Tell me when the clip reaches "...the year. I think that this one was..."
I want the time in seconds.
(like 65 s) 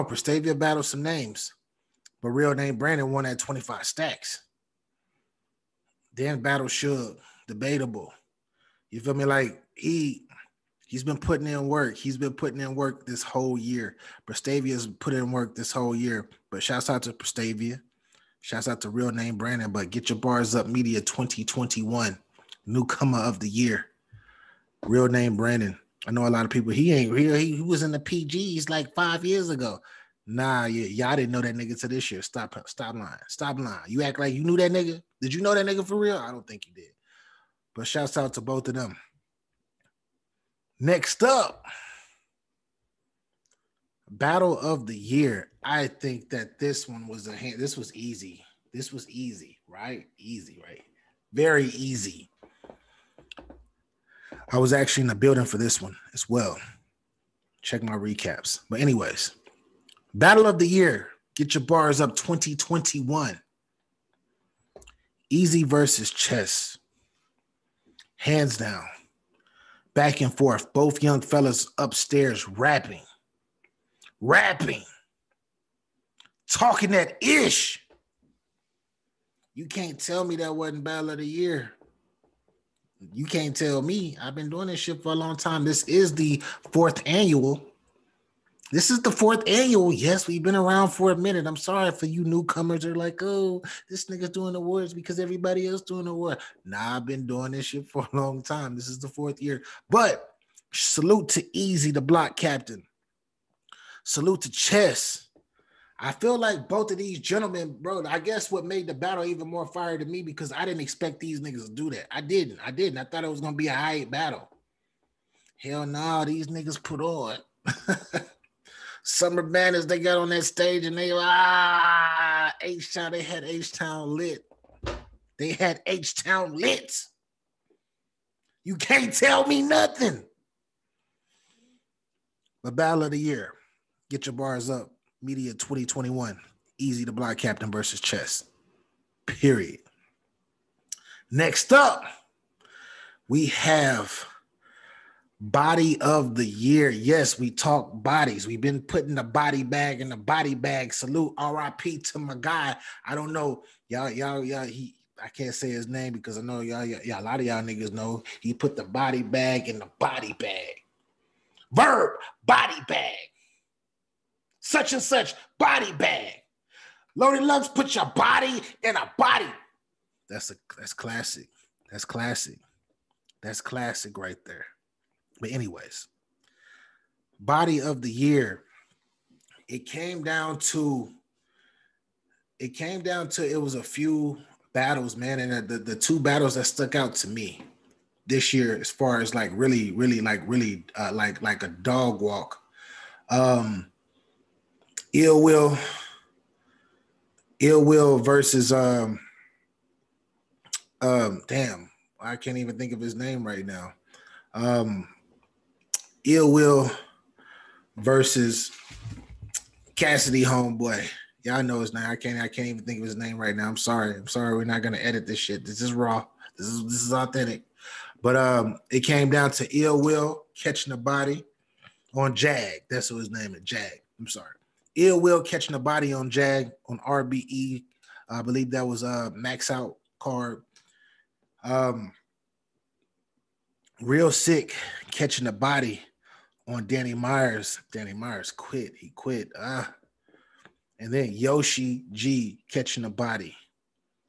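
44 s.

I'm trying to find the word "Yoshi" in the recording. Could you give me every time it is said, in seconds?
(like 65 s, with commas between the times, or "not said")
241 s.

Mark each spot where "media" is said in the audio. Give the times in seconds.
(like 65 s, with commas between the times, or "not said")
20 s, 135 s.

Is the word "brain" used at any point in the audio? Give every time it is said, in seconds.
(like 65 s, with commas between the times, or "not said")
not said.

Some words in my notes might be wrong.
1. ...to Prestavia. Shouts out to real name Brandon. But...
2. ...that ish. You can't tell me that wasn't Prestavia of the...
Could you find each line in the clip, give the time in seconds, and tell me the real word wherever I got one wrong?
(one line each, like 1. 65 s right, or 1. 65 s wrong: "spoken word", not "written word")
1. 17 s right
2. 76 s wrong: "Battle", not "Prestavia".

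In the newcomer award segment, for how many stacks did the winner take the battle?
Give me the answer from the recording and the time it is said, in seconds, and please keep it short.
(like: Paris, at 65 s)
25, at 3 s.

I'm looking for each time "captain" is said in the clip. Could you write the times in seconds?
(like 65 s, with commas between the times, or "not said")
102 s, 137 s.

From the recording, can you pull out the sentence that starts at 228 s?
I believe that was a uh, max out card.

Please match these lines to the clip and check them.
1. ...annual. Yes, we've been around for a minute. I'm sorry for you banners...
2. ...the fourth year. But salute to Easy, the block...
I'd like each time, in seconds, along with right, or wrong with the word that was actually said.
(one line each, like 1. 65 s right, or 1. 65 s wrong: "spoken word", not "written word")
1. 89 s wrong: "newcomers", not "banners"
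2. 98 s right.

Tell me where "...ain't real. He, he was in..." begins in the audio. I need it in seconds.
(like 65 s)
26 s.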